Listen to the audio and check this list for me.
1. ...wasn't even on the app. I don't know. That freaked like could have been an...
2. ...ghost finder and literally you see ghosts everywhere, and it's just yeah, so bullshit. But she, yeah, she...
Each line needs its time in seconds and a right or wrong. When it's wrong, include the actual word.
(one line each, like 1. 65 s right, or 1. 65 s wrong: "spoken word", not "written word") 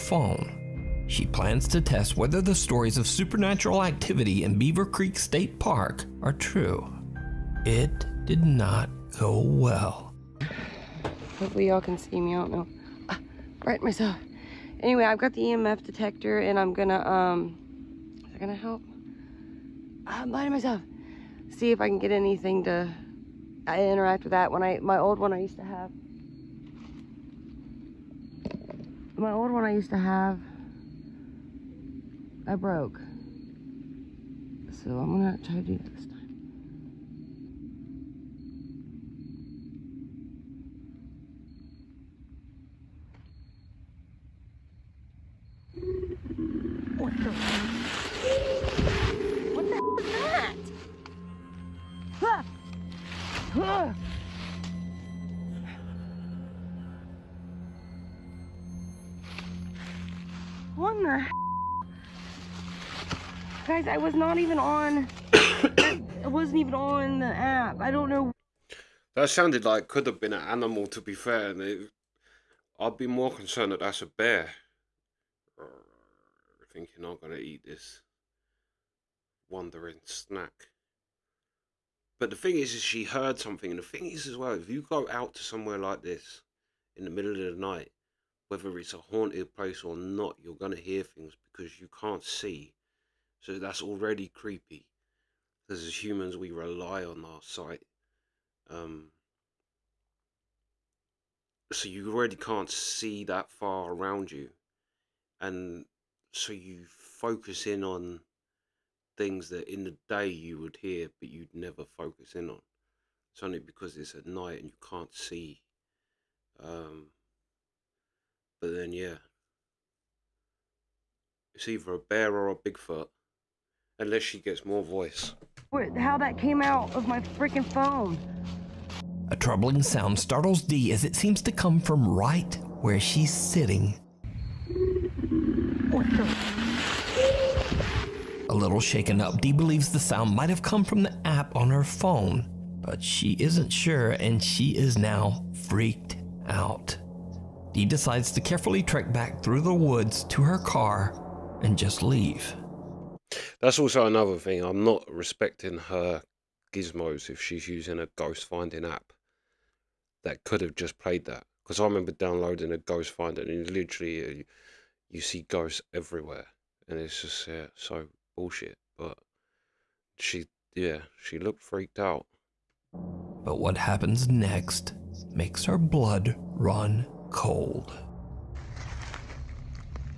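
1. 66 s wrong: "sounded", not "freaked"
2. 162 s right.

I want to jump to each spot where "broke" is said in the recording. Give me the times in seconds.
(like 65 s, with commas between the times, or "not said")
32 s.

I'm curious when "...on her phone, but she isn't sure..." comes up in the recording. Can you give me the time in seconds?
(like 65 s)
141 s.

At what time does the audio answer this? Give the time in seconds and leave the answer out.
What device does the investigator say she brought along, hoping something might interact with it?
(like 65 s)
15 s.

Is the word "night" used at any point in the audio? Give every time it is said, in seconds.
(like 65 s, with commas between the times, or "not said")
87 s, 114 s.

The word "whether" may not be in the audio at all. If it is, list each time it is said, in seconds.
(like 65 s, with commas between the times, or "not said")
2 s, 88 s.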